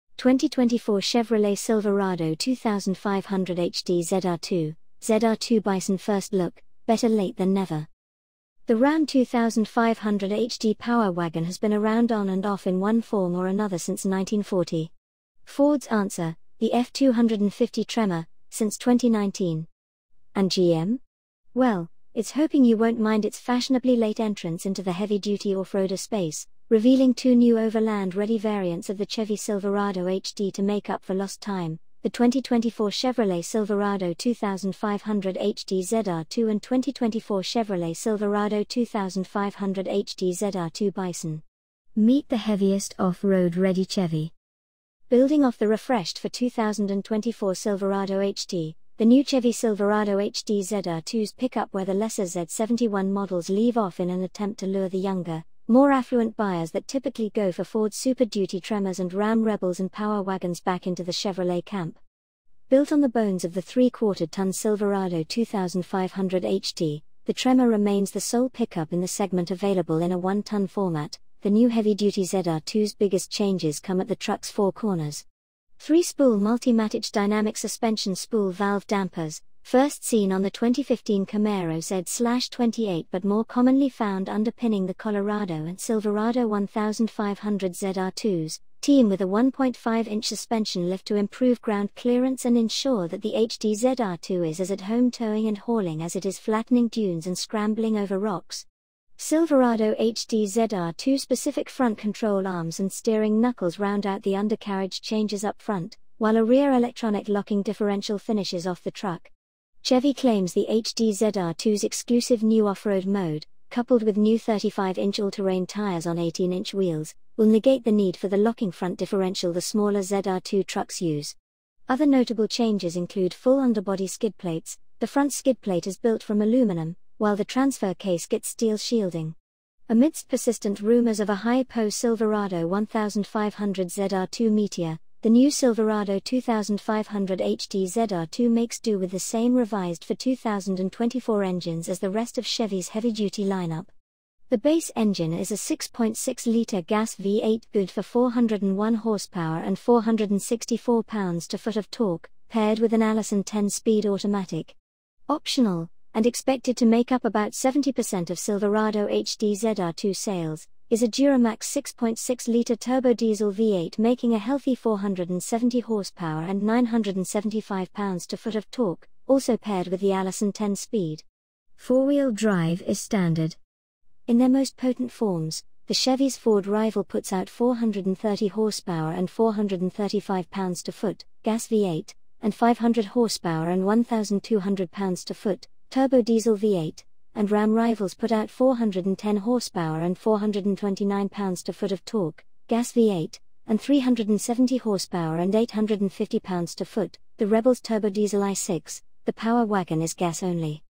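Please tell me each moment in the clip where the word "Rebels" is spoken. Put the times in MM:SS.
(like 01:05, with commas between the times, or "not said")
00:59, 03:17.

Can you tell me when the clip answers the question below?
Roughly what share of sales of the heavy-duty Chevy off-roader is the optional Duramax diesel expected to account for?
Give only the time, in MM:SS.
02:37.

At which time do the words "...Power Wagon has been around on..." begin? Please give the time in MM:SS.
00:10.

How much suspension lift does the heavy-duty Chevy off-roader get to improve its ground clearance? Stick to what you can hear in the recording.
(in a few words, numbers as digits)
1.5-inch.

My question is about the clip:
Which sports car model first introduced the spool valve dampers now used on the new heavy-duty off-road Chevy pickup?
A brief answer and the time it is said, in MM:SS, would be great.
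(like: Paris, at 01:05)
2015 Camaro Z-28, at 01:20.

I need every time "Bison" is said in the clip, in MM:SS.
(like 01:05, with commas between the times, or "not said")
00:05, 00:40.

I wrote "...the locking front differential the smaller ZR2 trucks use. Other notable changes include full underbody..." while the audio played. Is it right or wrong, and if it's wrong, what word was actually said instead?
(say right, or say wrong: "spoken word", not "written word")
right.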